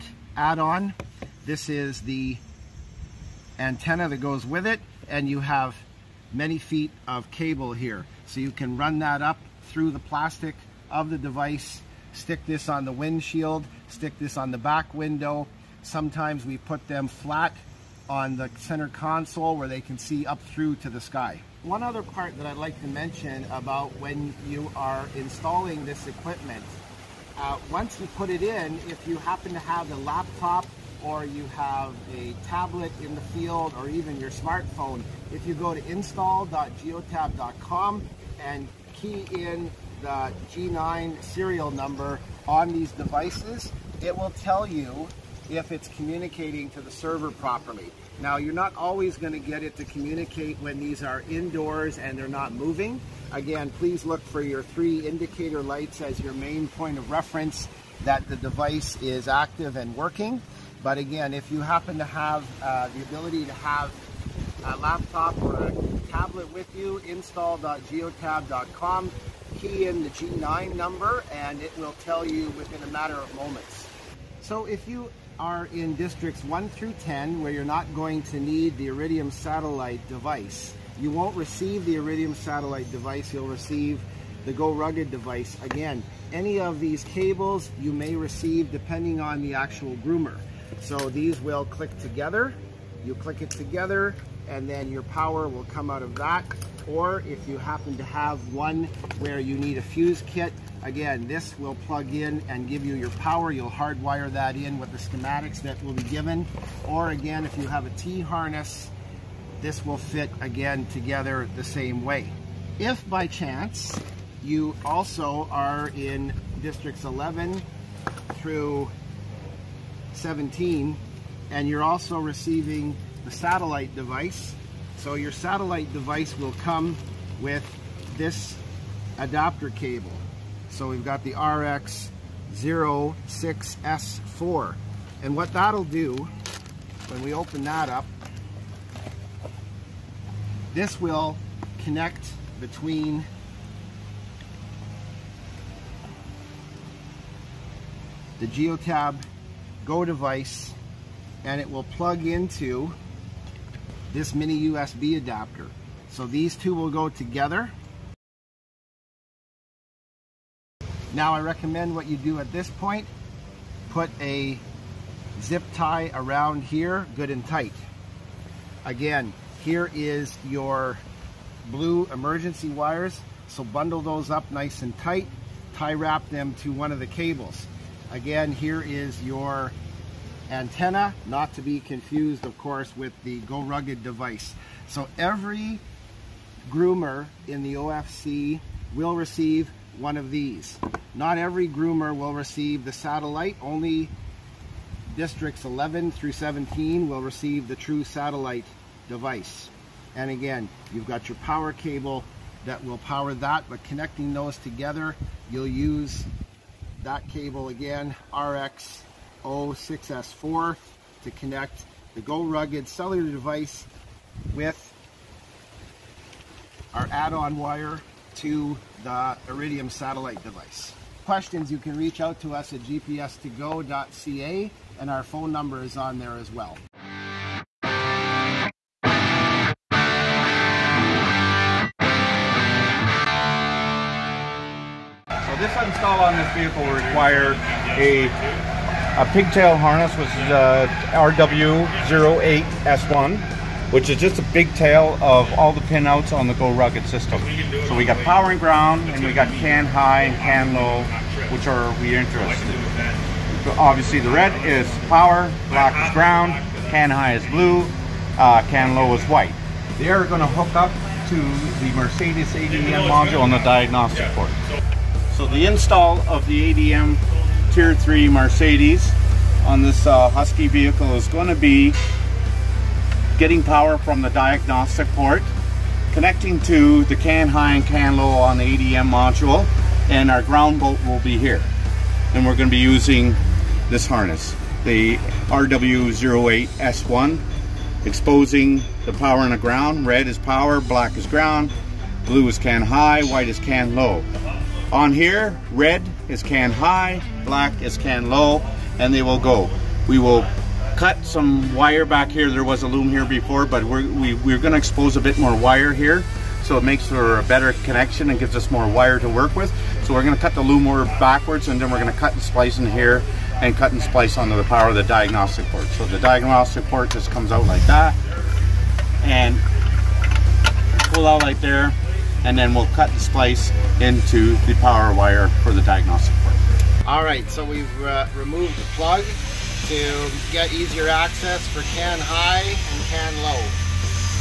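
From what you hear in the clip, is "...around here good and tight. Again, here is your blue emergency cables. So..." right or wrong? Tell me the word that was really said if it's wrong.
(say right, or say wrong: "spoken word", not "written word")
wrong: "wires", not "cables".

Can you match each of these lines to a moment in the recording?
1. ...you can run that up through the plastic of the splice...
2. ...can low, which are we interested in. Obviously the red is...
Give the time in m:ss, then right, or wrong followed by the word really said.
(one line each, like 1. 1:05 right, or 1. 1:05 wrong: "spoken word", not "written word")
1. 0:08 wrong: "device", not "splice"
2. 4:10 right.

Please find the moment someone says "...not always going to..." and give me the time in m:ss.
0:48.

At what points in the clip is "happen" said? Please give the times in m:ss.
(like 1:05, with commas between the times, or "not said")
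0:29, 1:01, 1:37.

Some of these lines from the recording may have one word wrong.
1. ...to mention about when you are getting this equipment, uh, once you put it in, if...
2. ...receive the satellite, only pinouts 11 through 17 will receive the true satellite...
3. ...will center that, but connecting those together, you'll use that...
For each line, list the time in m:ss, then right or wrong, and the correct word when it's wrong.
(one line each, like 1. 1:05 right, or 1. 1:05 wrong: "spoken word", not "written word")
1. 0:22 wrong: "installing", not "getting"
2. 3:12 wrong: "districts", not "pinouts"
3. 3:22 wrong: "power", not "center".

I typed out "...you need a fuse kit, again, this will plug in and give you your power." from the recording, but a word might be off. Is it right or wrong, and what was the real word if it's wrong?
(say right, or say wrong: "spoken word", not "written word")
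right.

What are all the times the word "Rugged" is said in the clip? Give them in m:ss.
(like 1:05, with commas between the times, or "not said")
1:24, 3:03, 3:32, 4:06.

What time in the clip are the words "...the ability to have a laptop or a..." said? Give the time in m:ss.
1:02.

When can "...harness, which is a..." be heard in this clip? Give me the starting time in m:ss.
3:59.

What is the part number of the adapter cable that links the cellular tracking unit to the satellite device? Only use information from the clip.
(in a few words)
RX06S4.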